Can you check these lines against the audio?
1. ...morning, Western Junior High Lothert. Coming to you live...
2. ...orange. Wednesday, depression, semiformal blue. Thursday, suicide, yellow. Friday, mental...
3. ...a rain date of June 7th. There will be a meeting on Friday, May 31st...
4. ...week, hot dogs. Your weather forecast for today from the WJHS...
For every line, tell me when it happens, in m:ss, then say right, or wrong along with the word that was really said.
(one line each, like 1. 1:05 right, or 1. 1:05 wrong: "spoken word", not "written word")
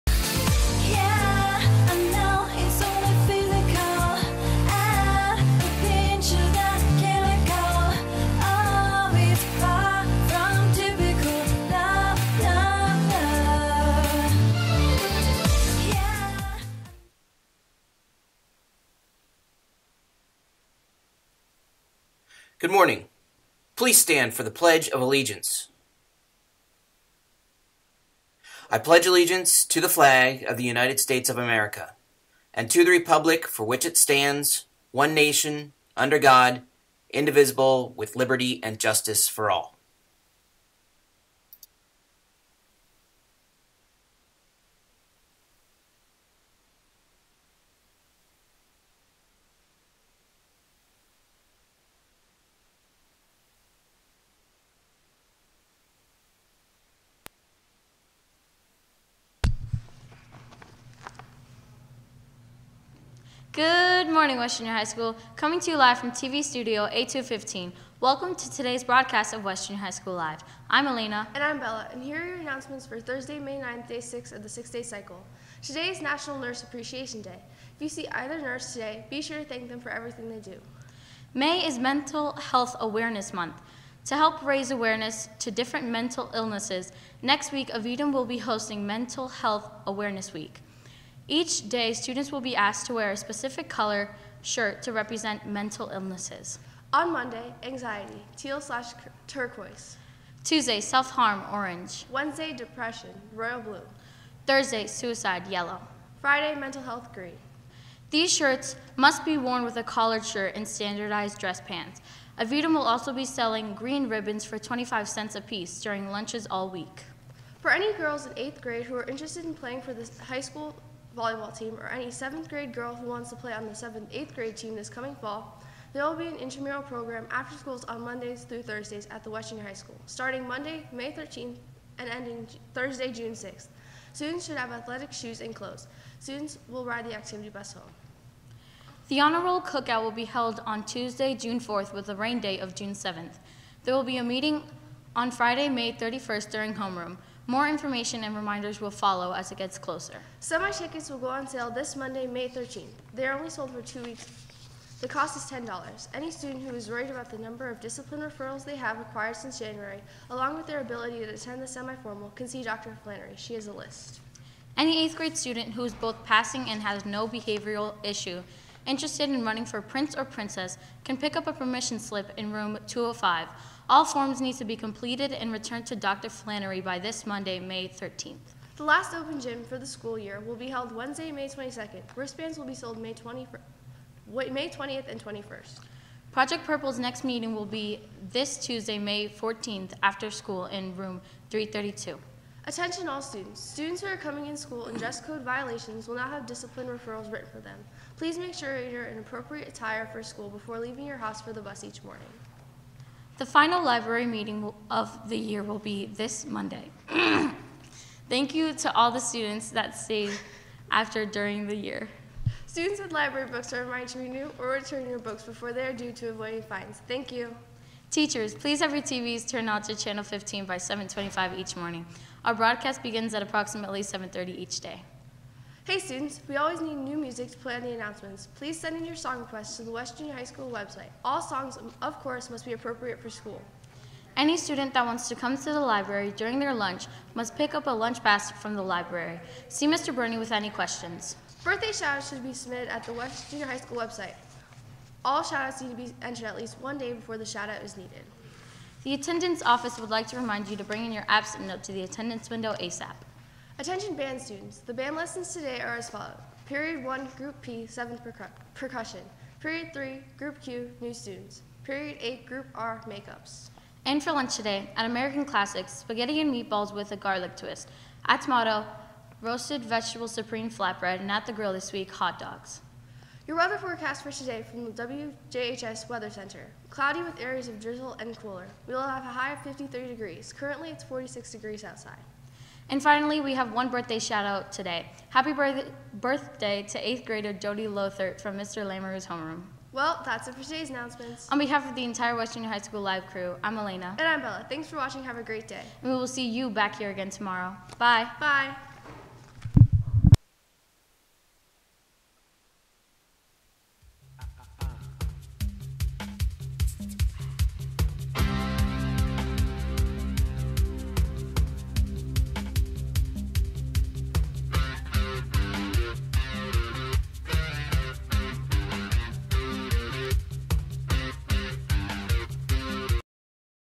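1. 1:04 wrong: "School", not "Lothert"
2. 1:41 wrong: "royal", not "semiformal"
3. 2:22 right
4. 4:31 right.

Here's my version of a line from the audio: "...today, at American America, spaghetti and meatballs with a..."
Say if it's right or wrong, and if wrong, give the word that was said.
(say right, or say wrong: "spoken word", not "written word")
wrong: "Classics", not "America".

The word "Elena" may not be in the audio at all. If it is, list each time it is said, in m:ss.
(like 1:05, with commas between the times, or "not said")
1:10, 4:53.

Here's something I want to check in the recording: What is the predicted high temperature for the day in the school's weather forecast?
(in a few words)
53 degrees.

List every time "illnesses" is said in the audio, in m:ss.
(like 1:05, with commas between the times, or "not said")
1:26, 1:35.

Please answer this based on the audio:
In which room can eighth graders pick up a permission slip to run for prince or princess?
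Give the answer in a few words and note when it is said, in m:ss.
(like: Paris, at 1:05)
room 205, at 2:52.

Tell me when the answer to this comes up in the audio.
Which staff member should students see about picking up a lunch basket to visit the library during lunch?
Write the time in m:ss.
3:59.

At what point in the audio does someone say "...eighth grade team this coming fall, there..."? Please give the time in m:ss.
2:04.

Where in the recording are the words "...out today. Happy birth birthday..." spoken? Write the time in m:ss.
4:44.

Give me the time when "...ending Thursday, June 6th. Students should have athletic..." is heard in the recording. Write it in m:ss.
2:12.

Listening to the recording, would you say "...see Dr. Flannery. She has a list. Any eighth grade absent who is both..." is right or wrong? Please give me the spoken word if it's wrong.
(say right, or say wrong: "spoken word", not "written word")
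wrong: "student", not "absent".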